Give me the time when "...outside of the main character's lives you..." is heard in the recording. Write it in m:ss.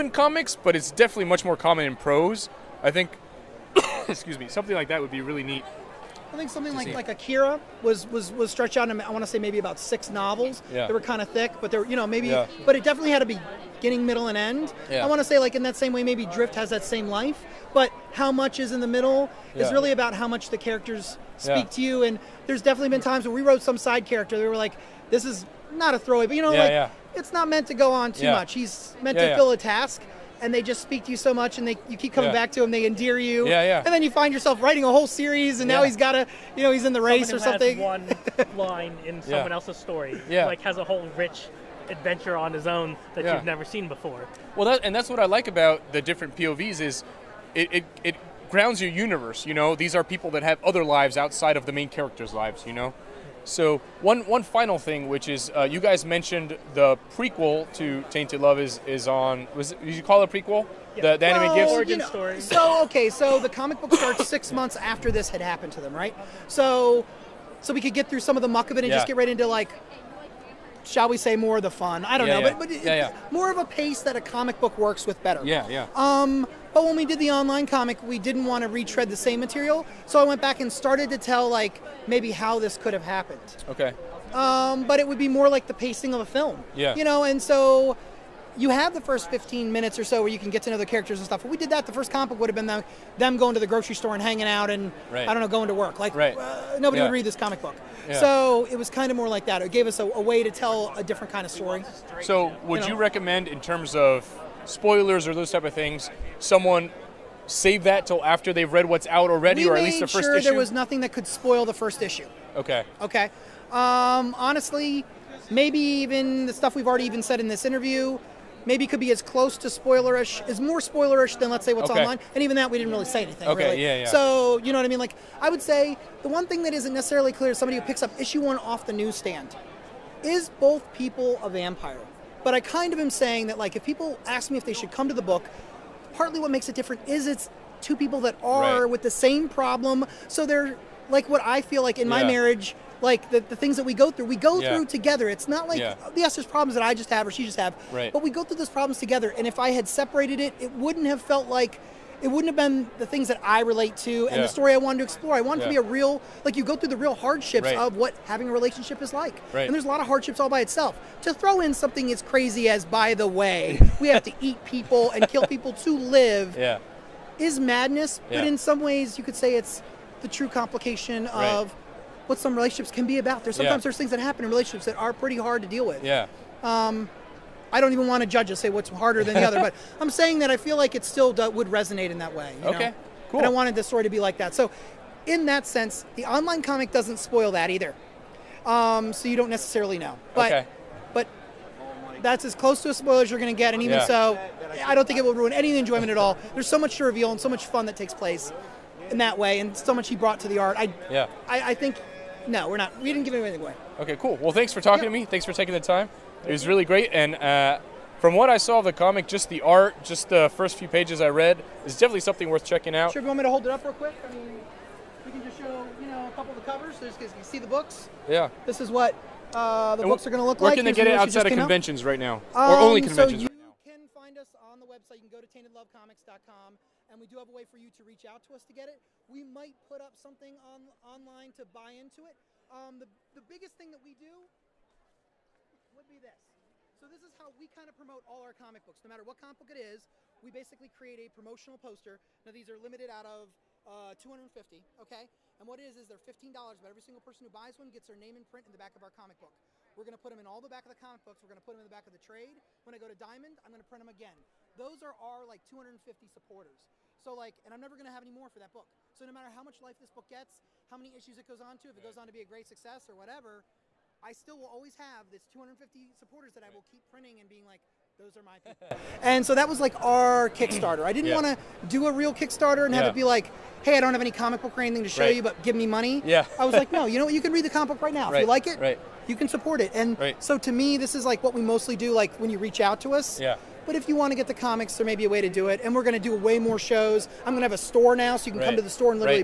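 0:51.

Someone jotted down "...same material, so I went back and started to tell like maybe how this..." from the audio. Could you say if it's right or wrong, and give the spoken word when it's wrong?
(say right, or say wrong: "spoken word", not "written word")
right.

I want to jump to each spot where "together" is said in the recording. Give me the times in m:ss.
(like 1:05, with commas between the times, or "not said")
2:24, 2:28.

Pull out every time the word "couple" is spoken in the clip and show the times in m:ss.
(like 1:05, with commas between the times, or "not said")
3:36.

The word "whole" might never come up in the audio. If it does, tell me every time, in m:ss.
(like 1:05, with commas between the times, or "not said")
0:34, 0:40.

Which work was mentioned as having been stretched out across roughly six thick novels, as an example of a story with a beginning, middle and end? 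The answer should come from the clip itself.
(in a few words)
Akira.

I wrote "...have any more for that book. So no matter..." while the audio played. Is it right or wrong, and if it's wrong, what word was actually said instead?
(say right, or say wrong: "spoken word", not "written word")
right.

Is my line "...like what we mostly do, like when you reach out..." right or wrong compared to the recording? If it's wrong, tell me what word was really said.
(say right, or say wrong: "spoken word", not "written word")
right.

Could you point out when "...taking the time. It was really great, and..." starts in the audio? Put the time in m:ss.
3:25.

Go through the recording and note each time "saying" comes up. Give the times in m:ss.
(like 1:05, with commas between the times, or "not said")
2:13, 3:00.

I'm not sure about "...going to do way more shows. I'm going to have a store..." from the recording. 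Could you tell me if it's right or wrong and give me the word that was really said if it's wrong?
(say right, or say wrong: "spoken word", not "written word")
right.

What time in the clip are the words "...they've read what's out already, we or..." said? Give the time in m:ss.
1:48.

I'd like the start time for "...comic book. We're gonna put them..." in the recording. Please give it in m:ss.
4:09.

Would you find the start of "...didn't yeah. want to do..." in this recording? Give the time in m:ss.
4:31.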